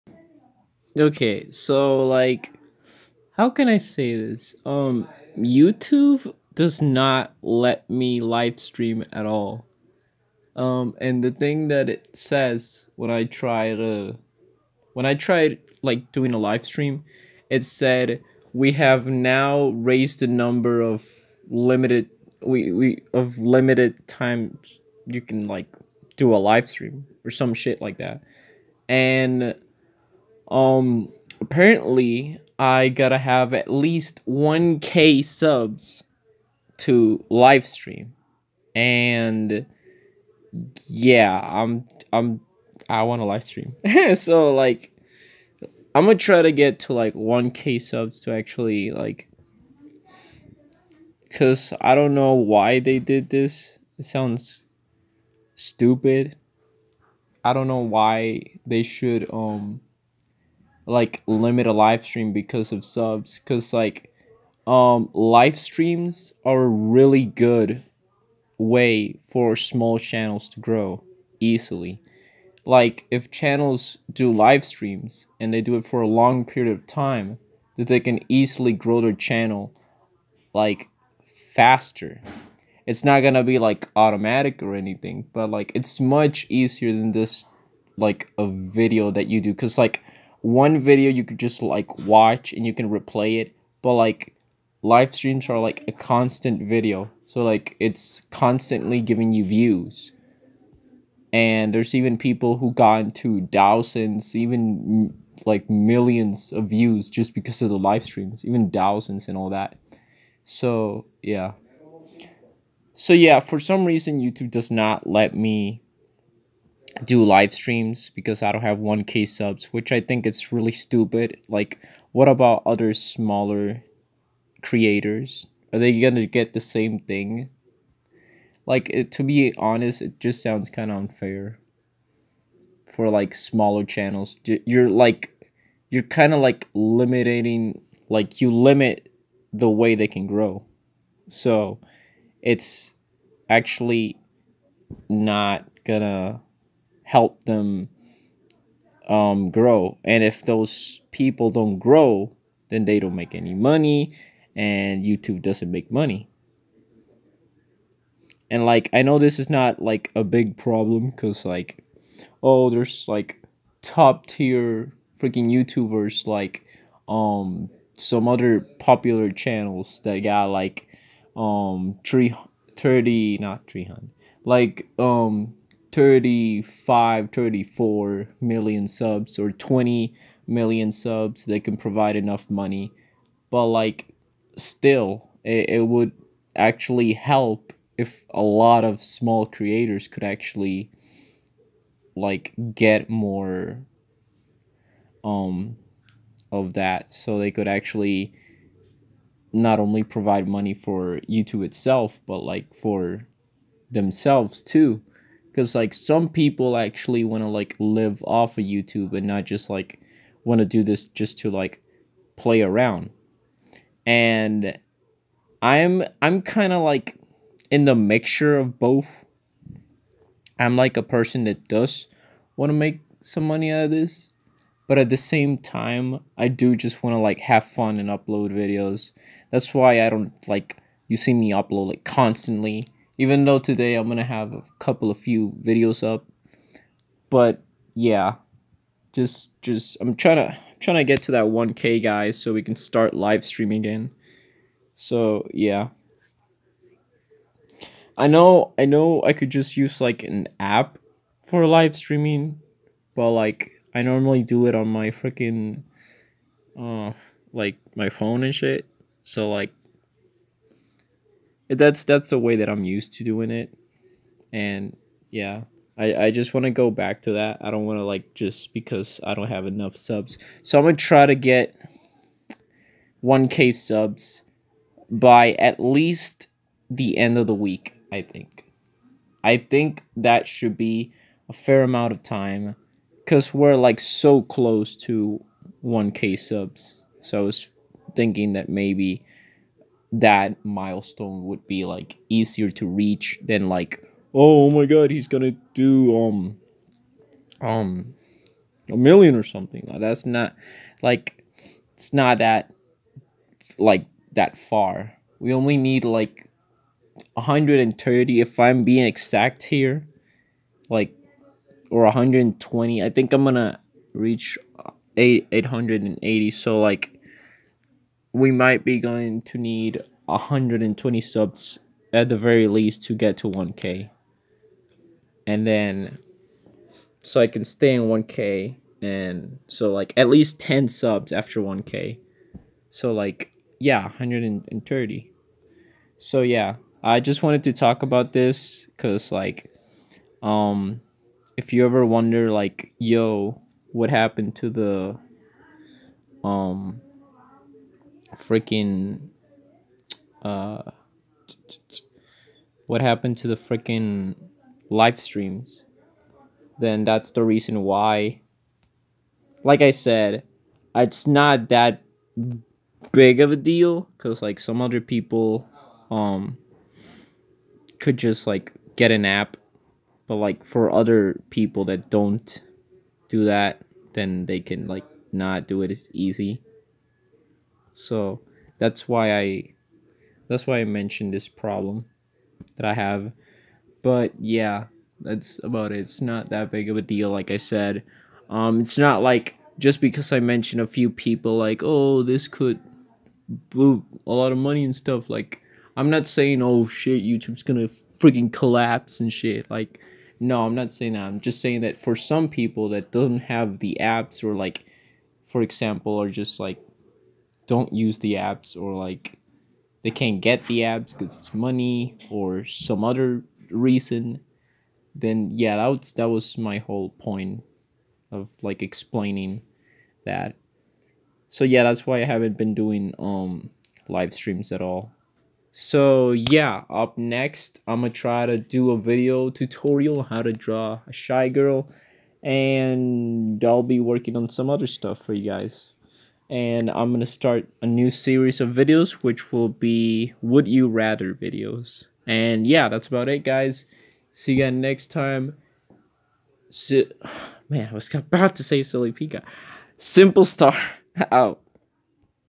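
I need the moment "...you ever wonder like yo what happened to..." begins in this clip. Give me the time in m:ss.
5:41.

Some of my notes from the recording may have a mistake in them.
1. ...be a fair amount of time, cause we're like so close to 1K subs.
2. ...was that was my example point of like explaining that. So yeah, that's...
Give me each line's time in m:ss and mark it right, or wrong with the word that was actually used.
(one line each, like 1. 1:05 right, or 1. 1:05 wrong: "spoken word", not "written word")
1. 4:40 right
2. 6:55 wrong: "whole", not "example".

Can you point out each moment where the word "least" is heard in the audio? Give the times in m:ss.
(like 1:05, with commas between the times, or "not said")
0:33, 4:35, 5:22, 5:30.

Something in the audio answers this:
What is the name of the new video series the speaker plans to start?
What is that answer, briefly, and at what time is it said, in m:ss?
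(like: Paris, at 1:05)
Would You Rather, at 7:20.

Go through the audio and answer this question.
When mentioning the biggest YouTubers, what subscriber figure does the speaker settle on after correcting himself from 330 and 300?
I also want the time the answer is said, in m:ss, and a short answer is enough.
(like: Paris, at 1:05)
35 million, at 2:55.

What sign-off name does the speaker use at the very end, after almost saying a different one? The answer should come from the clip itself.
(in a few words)
Simple Star.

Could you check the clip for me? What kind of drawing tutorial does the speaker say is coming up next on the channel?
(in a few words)
shy girl.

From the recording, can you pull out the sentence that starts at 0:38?
And yeah, I'm I'm I want to live stream.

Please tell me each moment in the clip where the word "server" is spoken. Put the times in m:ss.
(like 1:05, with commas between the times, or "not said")
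not said.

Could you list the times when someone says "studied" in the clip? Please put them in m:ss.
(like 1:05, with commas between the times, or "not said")
not said.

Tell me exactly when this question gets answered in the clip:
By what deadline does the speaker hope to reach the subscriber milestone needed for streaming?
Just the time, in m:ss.
4:37.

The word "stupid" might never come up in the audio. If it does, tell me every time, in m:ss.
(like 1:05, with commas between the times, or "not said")
0:55, 2:00.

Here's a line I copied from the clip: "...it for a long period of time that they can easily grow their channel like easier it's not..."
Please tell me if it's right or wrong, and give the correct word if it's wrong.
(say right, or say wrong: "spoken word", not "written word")
wrong: "faster", not "easier".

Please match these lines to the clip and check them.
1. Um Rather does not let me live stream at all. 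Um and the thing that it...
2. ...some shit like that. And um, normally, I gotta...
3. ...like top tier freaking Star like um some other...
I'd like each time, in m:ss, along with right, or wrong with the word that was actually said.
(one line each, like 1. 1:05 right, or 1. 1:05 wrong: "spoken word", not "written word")
1. 0:04 wrong: "YouTube", not "Rather"
2. 0:27 wrong: "apparently", not "normally"
3. 2:43 wrong: "YouTubers", not "Star".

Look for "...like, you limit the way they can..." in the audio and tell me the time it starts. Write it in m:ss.
2:18.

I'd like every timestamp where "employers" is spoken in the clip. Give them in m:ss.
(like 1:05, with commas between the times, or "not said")
not said.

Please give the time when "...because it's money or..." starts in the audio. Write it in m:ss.
6:51.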